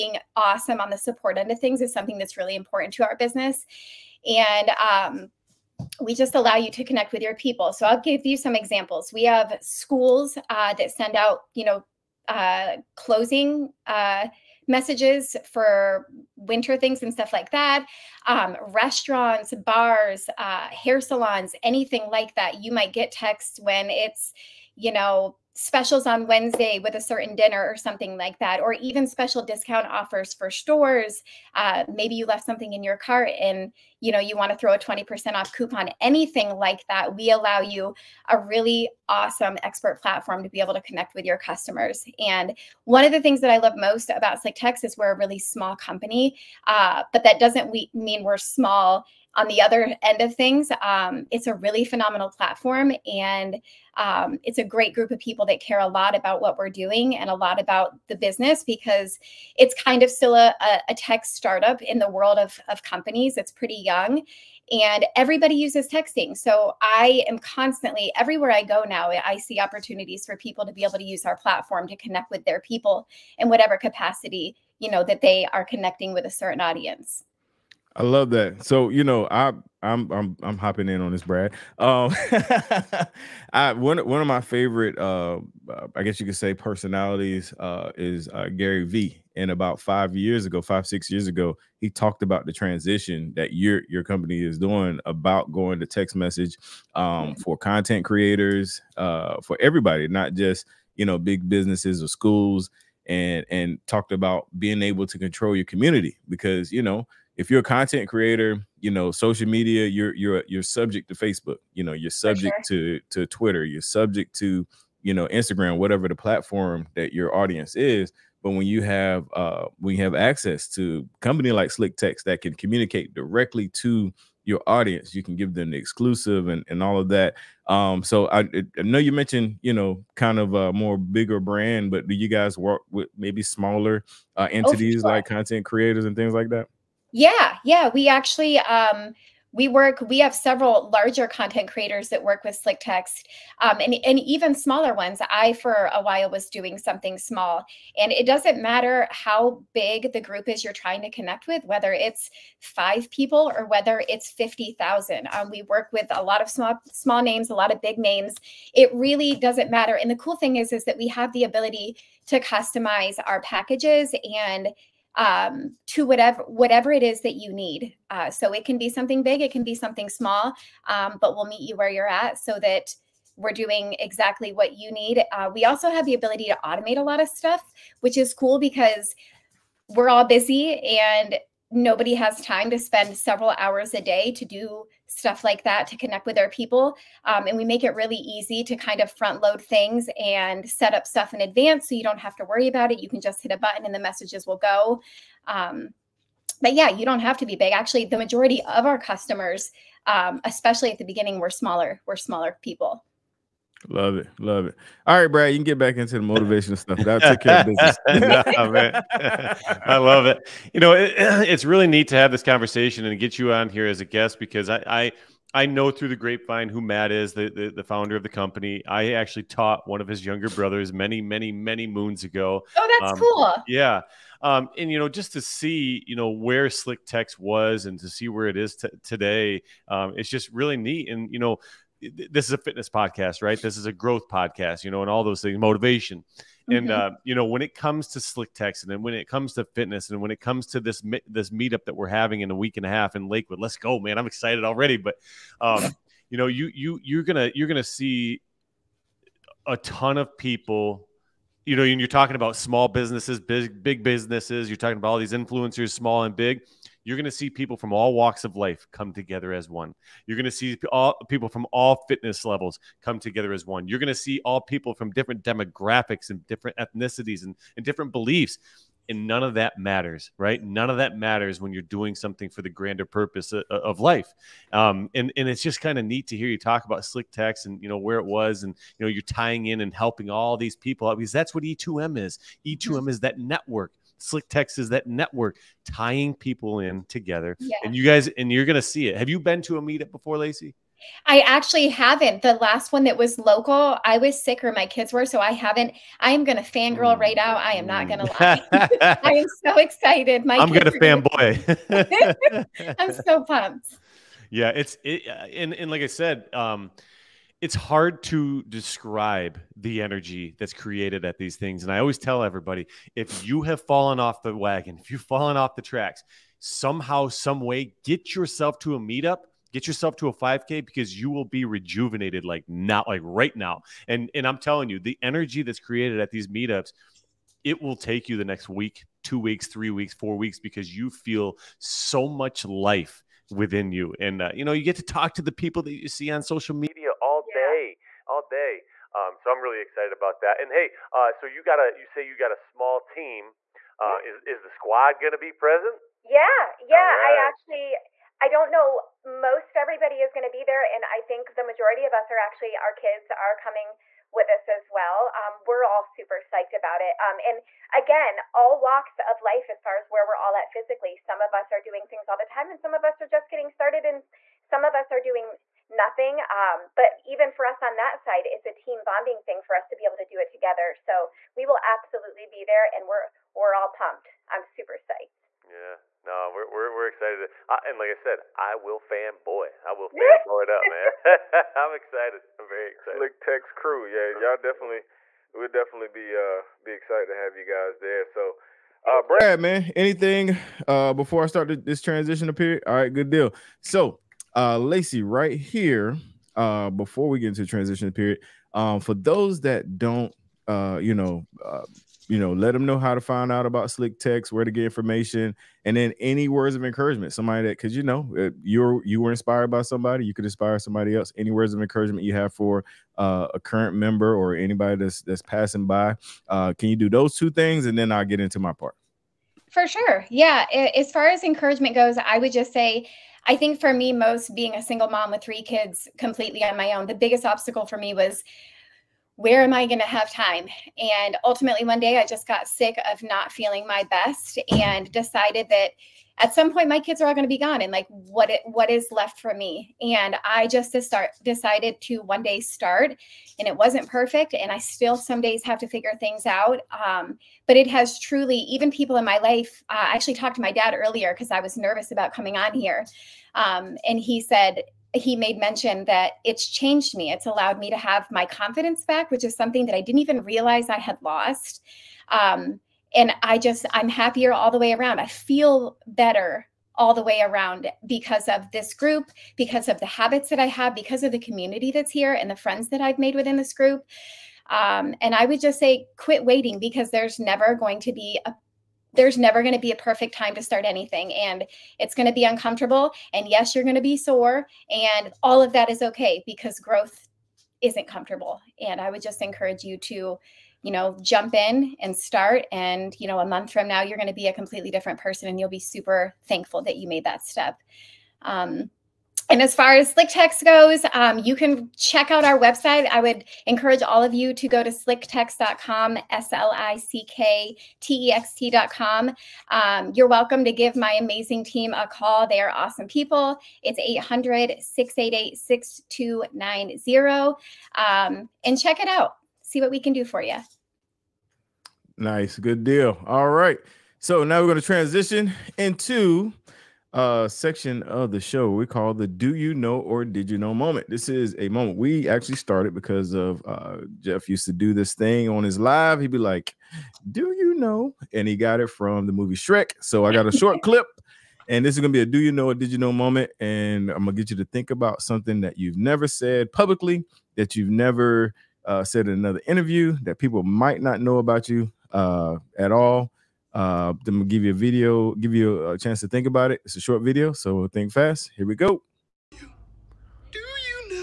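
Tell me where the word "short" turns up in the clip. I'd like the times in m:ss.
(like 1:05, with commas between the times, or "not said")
9:00, 9:17.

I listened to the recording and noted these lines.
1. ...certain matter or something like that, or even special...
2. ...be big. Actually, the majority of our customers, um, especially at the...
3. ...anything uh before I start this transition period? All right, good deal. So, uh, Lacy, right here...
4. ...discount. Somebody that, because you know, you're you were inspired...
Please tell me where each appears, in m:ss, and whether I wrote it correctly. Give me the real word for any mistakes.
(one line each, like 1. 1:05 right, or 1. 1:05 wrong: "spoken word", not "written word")
1. 0:27 wrong: "dinner", not "matter"
2. 3:17 right
3. 6:29 right
4. 6:46 wrong: "encouragement", not "discount".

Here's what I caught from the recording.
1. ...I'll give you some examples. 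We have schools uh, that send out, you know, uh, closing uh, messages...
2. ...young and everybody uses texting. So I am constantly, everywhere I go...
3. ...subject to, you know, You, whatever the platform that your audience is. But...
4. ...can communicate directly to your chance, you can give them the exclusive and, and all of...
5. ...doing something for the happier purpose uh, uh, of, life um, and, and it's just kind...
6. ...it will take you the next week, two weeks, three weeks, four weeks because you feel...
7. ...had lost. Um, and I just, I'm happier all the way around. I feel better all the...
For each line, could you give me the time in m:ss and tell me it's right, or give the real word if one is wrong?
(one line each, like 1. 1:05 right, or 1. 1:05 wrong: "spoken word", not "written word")
1. 0:07 right
2. 1:03 right
3. 1:53 wrong: "Instagram", not "You"
4. 2:02 wrong: "audience", not "chance"
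5. 4:31 wrong: "grander", not "happier"
6. 5:27 right
7. 7:40 right.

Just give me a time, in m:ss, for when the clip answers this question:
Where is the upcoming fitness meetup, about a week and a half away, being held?
4:03.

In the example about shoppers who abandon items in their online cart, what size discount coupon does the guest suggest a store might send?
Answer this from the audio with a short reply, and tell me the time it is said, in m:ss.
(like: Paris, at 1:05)
20% off, at 0:34.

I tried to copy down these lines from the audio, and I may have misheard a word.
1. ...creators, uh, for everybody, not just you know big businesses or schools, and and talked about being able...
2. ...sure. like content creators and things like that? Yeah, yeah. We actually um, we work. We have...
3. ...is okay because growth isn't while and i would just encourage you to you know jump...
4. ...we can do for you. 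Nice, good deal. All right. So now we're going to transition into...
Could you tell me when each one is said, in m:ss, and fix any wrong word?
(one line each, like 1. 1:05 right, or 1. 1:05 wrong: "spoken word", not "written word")
1. 1:38 right
2. 2:15 right
3. 8:05 wrong: "comfortable", not "while"
4. 8:39 right.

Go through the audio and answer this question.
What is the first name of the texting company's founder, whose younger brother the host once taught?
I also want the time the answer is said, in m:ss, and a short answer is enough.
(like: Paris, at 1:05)
Matt, at 3:36.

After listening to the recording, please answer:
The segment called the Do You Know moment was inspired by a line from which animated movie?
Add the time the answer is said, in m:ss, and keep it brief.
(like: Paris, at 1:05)
Shrek, at 8:59.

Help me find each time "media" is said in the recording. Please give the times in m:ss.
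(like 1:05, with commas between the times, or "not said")
1:49, 5:36.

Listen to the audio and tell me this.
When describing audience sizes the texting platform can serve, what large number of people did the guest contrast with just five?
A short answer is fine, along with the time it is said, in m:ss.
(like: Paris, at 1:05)
50,000, at 2:34.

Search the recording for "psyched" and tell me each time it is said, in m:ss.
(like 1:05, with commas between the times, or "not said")
5:56, 6:14.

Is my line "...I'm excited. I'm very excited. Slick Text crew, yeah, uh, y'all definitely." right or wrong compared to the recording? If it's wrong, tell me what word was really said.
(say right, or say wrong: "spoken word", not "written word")
right.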